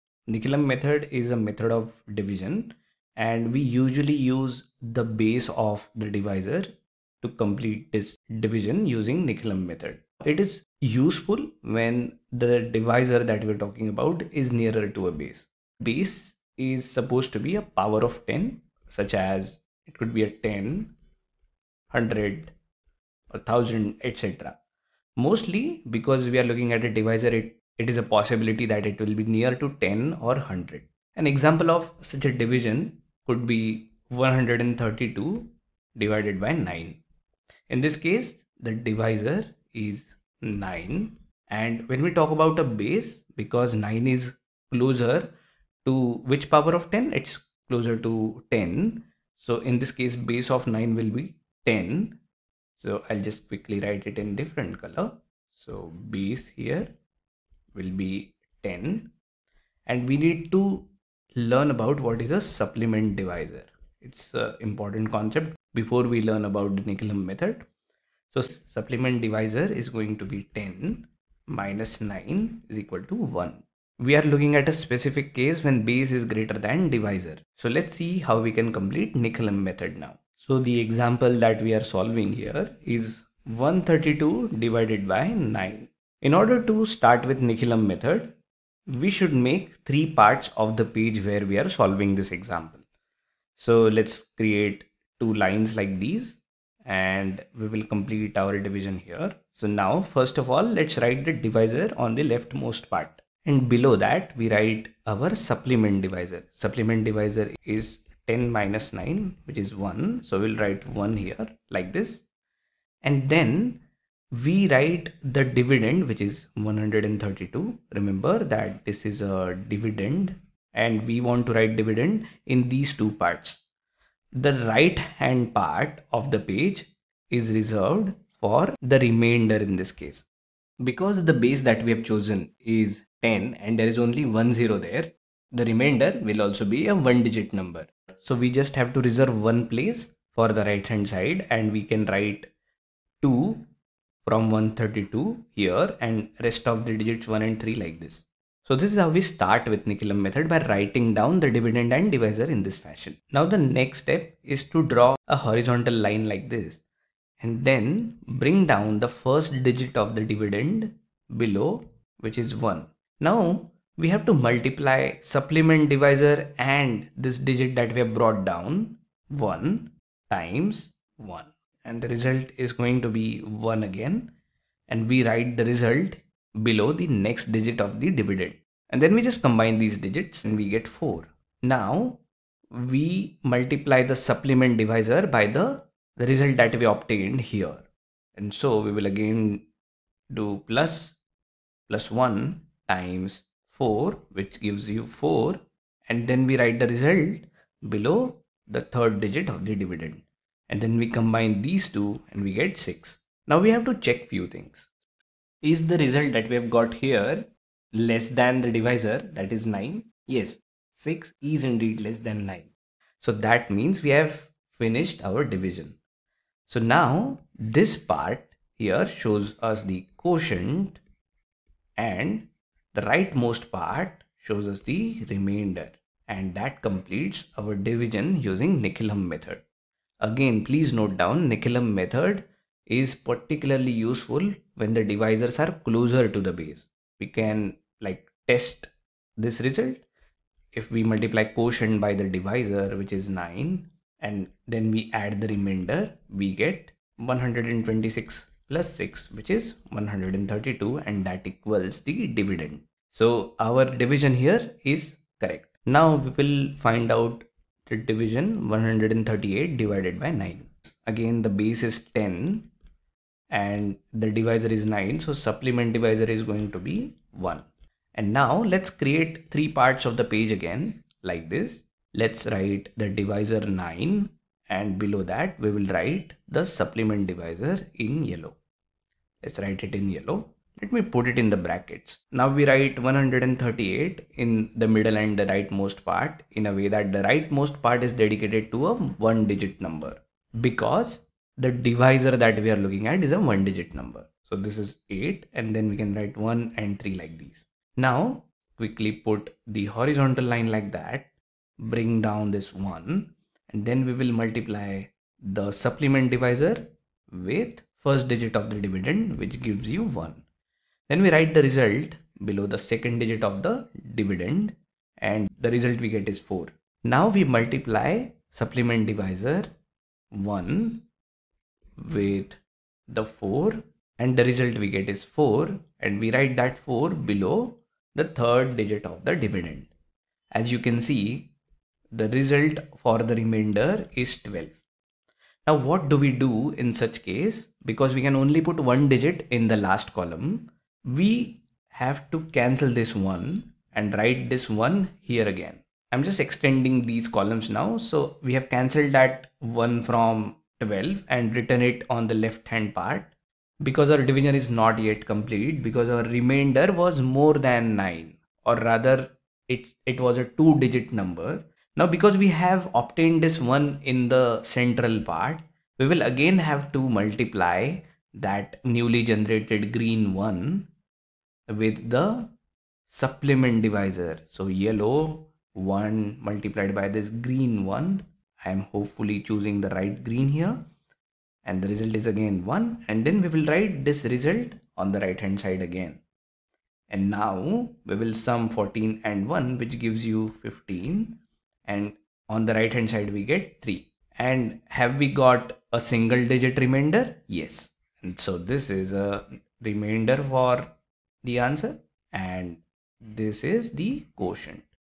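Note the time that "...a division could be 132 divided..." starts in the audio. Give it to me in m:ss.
0:32.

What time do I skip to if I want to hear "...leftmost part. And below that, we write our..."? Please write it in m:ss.
1:42.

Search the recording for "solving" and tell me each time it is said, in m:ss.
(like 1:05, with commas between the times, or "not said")
1:21, 1:31.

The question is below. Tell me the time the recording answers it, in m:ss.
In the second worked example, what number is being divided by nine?
4:18.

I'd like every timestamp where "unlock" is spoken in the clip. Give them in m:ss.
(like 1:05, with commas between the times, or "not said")
not said.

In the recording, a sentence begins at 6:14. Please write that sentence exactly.
So yellow one multiplied by this green one.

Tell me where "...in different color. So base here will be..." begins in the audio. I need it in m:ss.
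0:54.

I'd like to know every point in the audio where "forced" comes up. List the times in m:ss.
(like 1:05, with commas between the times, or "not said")
not said.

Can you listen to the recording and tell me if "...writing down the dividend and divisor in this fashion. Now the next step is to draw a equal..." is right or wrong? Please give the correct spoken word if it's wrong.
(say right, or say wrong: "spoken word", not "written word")
wrong: "horizontal", not "equal".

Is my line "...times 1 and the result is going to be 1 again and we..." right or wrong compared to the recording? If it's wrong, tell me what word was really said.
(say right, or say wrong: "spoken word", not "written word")
right.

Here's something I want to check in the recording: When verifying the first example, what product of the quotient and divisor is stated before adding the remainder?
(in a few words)
126.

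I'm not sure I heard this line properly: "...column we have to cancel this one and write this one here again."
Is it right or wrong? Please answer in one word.
right.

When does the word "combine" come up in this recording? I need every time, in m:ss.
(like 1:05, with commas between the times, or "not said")
2:59, 3:21.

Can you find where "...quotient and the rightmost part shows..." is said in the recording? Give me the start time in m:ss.
3:40.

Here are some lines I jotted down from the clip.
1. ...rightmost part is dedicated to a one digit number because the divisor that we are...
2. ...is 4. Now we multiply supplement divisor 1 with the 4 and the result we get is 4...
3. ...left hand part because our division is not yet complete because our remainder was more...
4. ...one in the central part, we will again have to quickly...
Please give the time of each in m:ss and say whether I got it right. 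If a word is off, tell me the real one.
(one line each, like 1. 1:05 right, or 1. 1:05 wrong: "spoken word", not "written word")
1. 4:47 right
2. 5:16 right
3. 5:52 right
4. 6:03 wrong: "multiply", not "quickly".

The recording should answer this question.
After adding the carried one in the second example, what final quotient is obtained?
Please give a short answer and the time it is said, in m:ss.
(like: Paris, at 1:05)
15, at 6:30.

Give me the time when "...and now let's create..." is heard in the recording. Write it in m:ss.
4:28.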